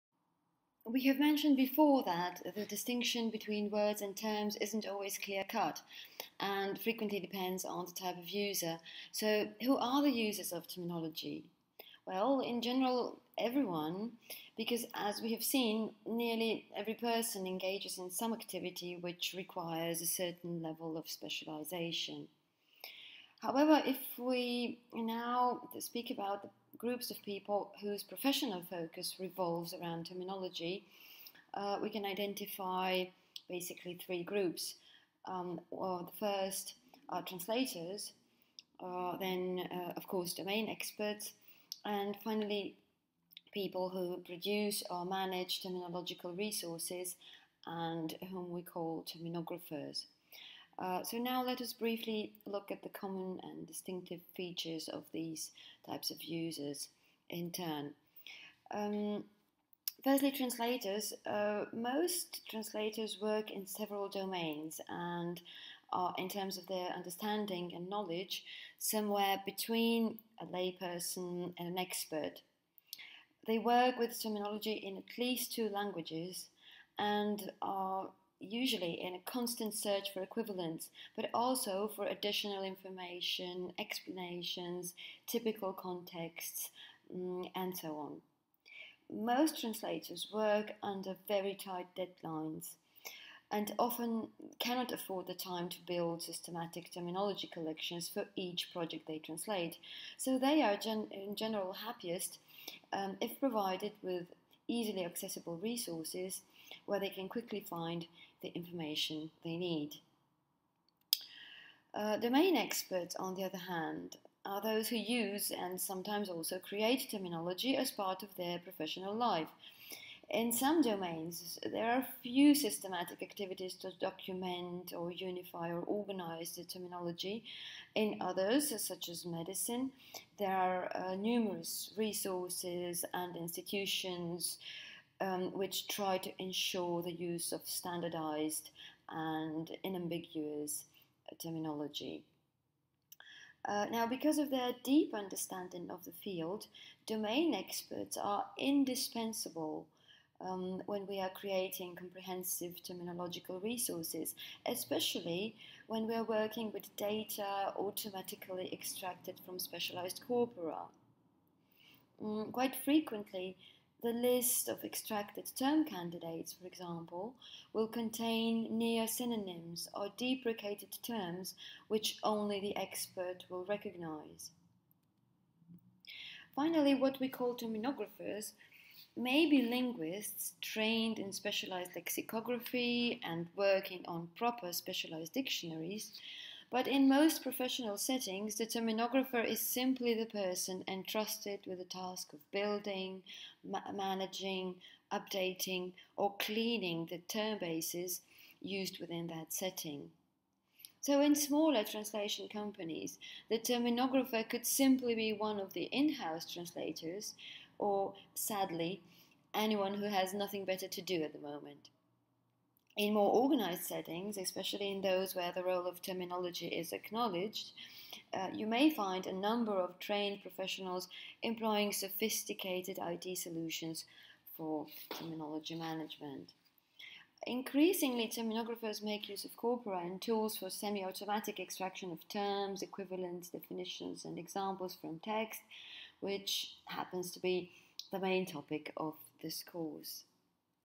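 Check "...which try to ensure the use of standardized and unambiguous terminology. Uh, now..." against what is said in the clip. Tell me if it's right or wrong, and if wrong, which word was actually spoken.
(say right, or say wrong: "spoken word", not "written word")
right.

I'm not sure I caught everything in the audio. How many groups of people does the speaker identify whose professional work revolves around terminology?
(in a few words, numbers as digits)
3.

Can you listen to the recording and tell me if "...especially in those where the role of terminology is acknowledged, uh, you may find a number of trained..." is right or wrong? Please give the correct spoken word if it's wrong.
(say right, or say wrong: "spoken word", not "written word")
right.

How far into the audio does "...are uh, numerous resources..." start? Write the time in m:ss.
2:10.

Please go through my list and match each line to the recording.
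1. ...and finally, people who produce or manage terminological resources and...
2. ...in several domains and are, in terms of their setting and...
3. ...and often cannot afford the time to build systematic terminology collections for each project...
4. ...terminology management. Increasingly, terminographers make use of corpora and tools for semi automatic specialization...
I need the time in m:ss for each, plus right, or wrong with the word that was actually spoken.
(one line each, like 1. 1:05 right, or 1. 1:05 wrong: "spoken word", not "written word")
1. 0:41 right
2. 1:03 wrong: "understanding", not "setting"
3. 1:33 right
4. 3:45 wrong: "extraction", not "specialization".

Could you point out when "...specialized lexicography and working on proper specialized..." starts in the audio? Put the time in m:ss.
3:01.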